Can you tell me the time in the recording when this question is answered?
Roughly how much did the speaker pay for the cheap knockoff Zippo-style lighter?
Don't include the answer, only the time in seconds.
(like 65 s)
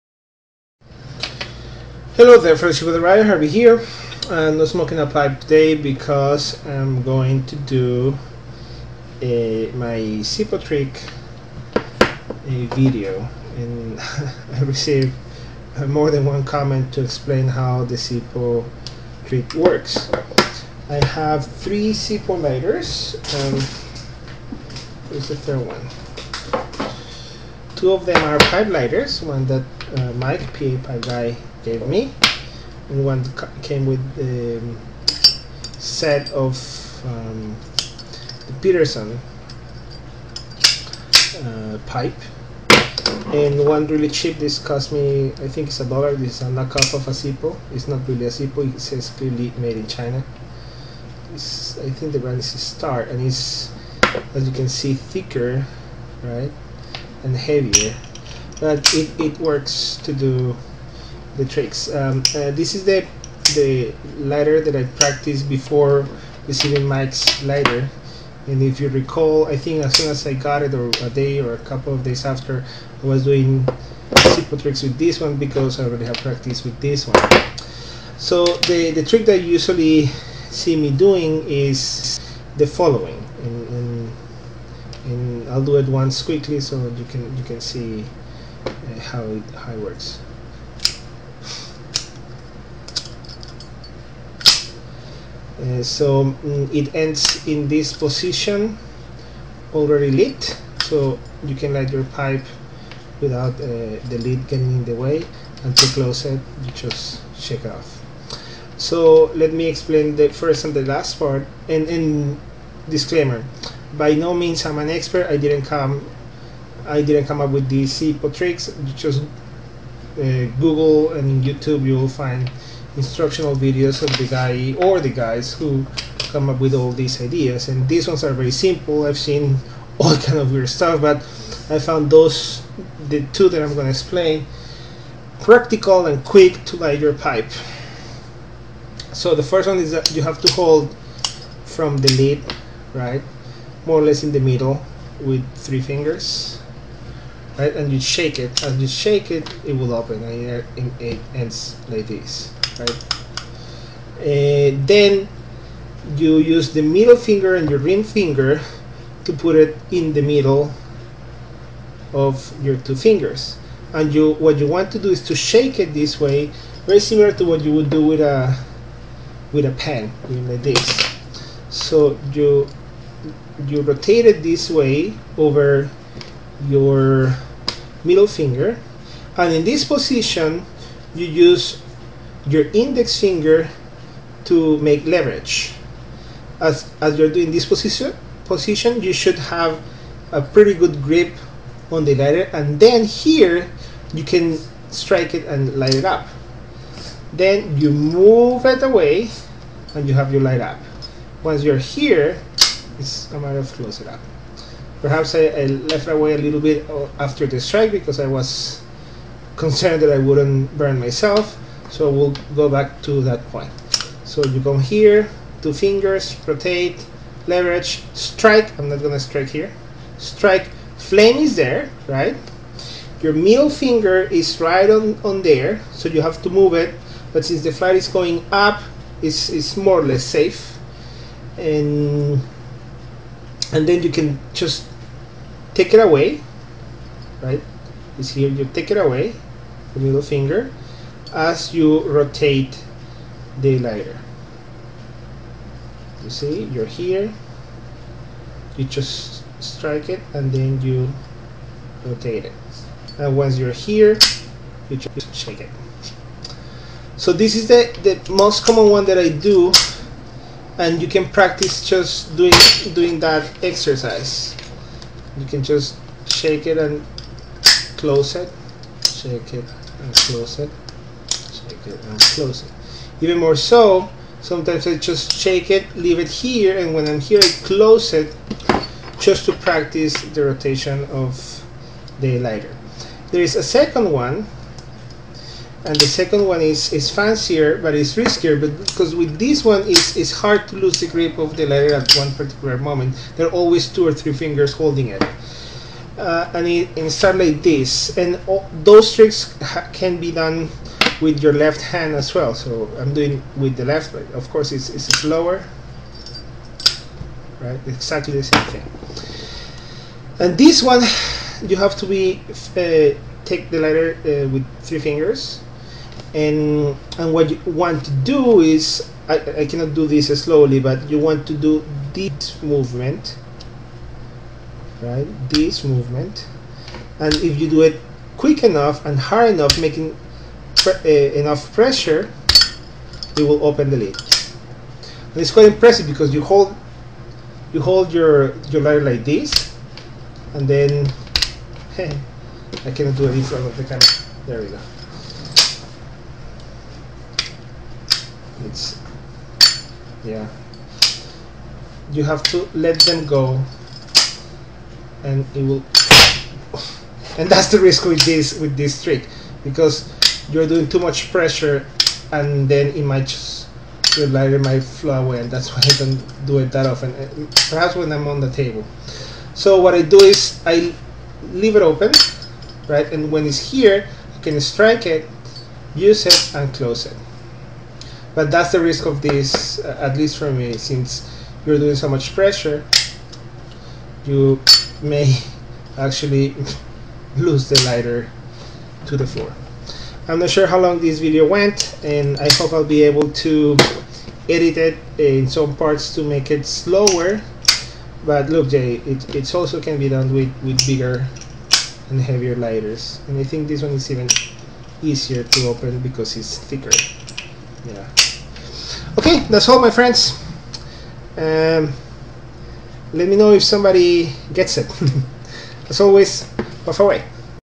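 45 s.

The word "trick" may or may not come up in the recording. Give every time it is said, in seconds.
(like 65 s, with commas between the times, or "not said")
10 s, 19 s, 61 s, 74 s, 79 s, 118 s, 299 s, 359 s.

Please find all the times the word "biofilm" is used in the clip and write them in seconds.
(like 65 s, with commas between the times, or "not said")
not said.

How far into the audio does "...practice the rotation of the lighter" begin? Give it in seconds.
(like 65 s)
279 s.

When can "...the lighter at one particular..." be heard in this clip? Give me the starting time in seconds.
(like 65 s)
291 s.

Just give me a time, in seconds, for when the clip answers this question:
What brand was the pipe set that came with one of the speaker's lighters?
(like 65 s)
38 s.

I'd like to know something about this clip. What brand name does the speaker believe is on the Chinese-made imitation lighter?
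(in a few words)
Star.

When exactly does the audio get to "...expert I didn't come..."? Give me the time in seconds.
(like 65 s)
114 s.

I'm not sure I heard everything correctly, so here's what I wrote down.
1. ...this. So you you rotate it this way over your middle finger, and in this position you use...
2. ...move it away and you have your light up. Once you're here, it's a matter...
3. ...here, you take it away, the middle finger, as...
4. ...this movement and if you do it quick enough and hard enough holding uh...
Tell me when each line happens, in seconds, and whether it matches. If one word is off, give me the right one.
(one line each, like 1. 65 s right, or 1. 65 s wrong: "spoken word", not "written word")
1. 170 s right
2. 197 s right
3. 238 s right
4. 325 s wrong: "making", not "holding".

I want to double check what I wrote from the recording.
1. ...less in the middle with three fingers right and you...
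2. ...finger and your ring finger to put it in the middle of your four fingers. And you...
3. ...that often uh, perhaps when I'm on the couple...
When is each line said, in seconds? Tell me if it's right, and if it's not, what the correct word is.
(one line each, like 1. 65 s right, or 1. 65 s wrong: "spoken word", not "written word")
1. 144 s right
2. 157 s wrong: "two", not "four"
3. 366 s wrong: "table", not "couple".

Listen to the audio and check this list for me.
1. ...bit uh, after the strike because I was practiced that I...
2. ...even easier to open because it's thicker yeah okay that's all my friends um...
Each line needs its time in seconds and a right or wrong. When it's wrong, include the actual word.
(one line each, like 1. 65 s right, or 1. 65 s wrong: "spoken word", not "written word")
1. 206 s wrong: "concerned", not "practiced"
2. 404 s right.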